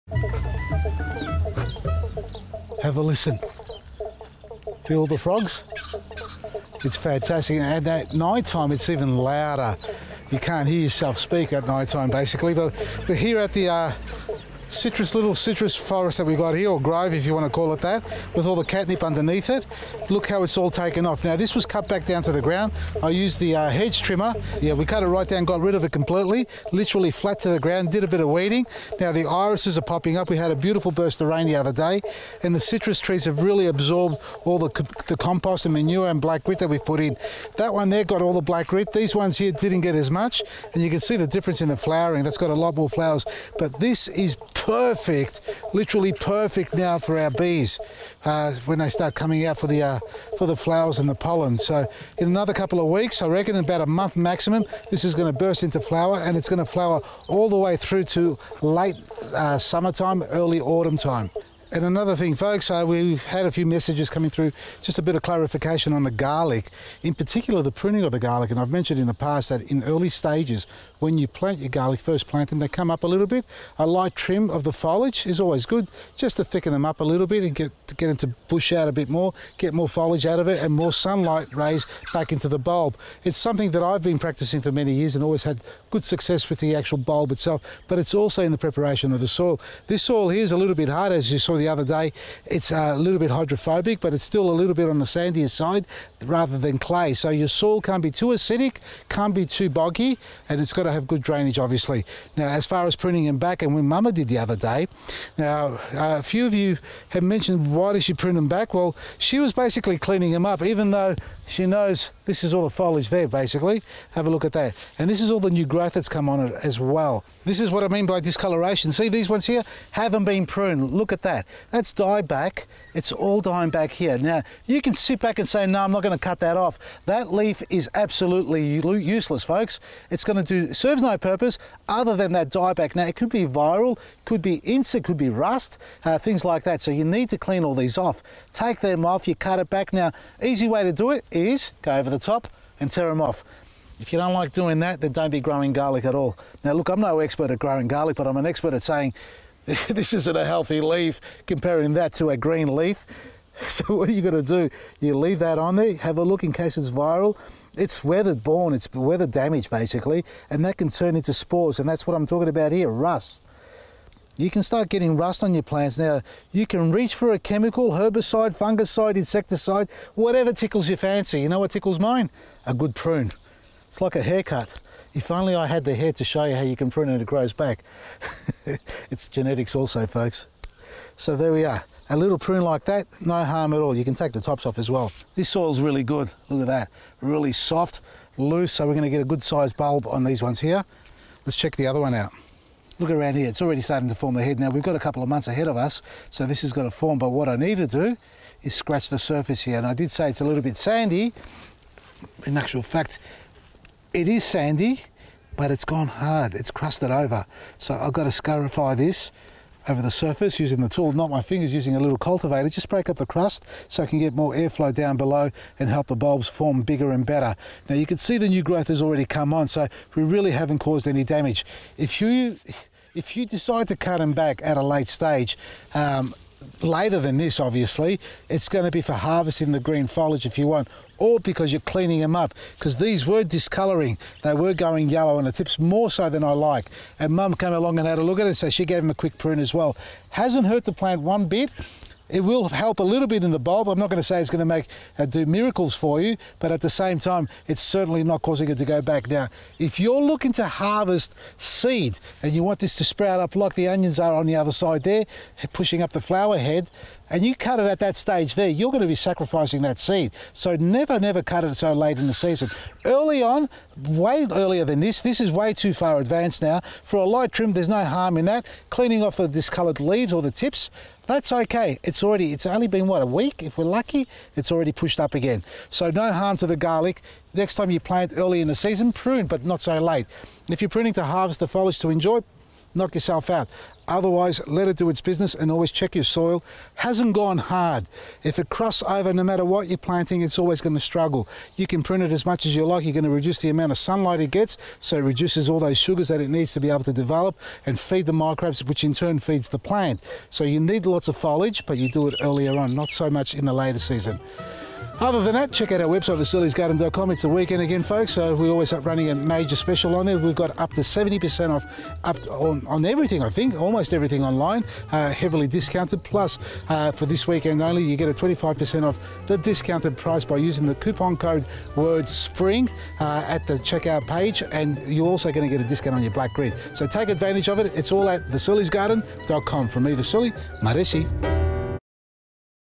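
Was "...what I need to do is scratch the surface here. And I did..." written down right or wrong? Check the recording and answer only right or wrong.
right.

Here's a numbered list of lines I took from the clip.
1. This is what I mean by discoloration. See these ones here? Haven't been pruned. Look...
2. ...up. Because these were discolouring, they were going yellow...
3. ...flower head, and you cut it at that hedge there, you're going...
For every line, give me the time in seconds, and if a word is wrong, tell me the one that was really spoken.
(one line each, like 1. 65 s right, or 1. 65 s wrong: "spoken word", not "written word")
1. 117 s right
2. 232 s right
3. 256 s wrong: "stage", not "hedge".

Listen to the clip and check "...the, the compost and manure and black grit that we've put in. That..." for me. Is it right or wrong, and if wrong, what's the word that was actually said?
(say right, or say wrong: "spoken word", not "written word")
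right.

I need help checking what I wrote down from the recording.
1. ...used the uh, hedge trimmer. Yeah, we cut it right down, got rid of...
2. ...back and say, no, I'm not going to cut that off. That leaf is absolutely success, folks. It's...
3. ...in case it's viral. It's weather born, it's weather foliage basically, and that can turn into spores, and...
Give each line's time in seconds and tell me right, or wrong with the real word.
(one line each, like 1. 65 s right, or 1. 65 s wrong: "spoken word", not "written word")
1. 23 s right
2. 125 s wrong: "useless", not "success"
3. 156 s wrong: "damage", not "foliage".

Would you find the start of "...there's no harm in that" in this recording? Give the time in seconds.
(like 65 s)
267 s.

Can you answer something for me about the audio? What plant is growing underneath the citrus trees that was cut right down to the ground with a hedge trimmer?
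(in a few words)
catnip.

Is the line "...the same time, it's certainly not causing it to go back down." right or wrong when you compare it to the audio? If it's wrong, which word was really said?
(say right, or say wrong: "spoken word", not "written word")
right.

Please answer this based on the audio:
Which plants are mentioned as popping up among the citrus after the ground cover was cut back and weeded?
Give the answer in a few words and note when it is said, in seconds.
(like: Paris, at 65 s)
irises, at 29 s.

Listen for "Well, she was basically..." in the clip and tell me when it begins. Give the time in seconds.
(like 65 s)
108 s.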